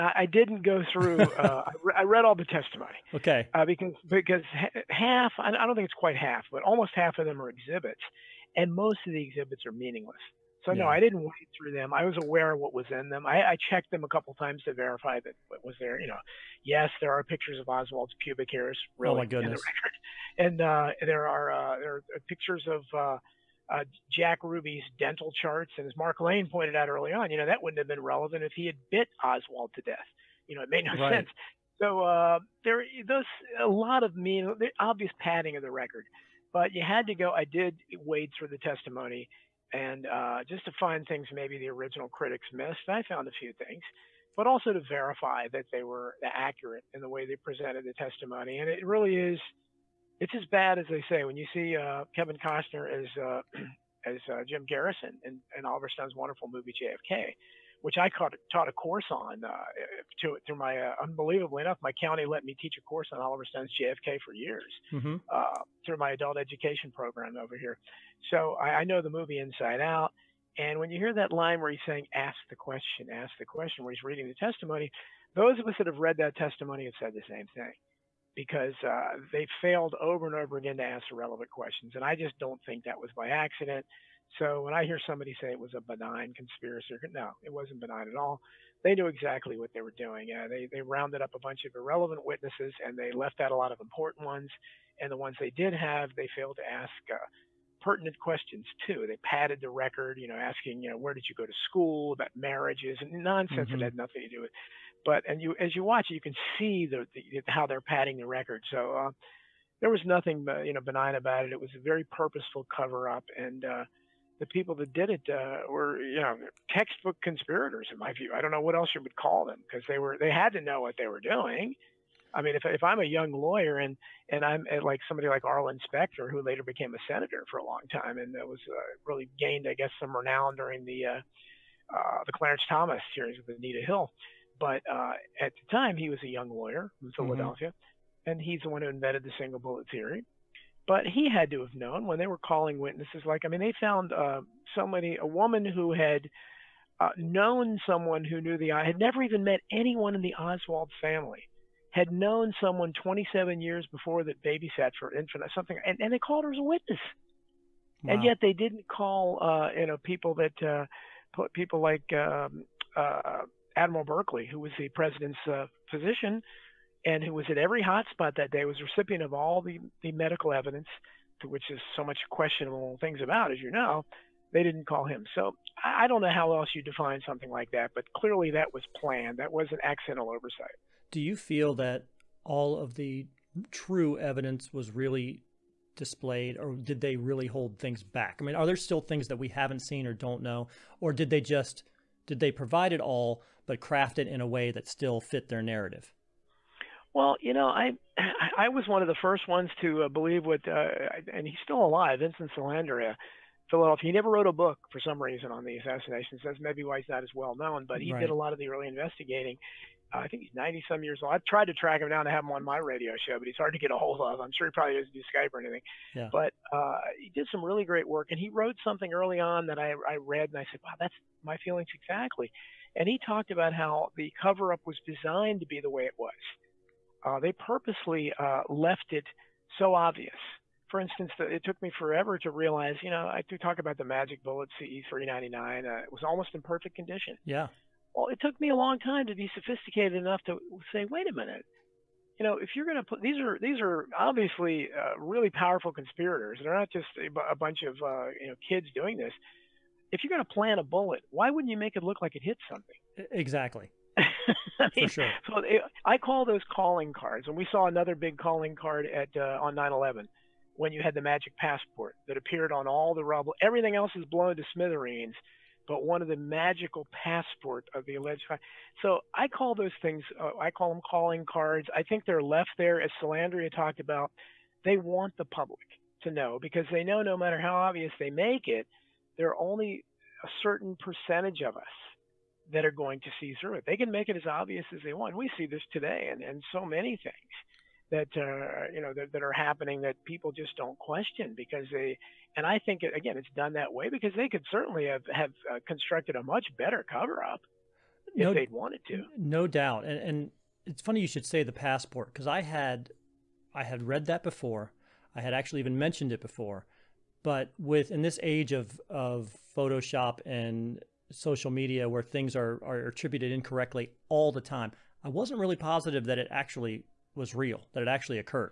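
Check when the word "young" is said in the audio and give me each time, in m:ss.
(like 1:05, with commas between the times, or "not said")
2:03, 2:16.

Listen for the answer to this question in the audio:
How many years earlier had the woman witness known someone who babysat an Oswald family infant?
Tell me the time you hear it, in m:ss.
2:33.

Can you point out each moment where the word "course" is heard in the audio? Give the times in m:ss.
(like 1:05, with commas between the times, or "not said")
0:58, 1:02.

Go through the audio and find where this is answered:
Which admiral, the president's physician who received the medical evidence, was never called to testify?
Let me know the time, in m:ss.
2:43.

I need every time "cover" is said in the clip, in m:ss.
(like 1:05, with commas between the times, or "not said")
1:52, 3:44, 4:57.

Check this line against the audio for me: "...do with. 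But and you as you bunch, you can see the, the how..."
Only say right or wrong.
wrong.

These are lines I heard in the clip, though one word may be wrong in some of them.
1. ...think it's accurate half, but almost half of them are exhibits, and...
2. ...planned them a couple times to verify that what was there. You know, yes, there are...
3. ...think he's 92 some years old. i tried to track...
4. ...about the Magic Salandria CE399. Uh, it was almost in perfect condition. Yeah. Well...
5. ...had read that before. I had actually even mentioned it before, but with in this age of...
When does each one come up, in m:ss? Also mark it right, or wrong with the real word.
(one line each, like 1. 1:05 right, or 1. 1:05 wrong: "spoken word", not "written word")
1. 0:05 wrong: "quite", not "accurate"
2. 0:13 wrong: "checked", not "planned"
3. 3:30 wrong: "90", not "92"
4. 3:53 wrong: "Bullet", not "Salandria"
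5. 5:03 right.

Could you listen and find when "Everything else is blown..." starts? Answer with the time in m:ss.
4:23.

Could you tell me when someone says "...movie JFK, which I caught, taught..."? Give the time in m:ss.
0:56.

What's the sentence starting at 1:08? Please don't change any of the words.
So I, I, know the movie inside out.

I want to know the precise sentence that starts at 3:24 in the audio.
He never wrote a book for some reason on the assassinations.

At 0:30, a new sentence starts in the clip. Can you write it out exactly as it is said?
You know, it made no right.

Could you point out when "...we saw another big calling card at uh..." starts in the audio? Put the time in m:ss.
4:17.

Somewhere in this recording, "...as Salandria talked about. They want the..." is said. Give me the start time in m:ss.
4:32.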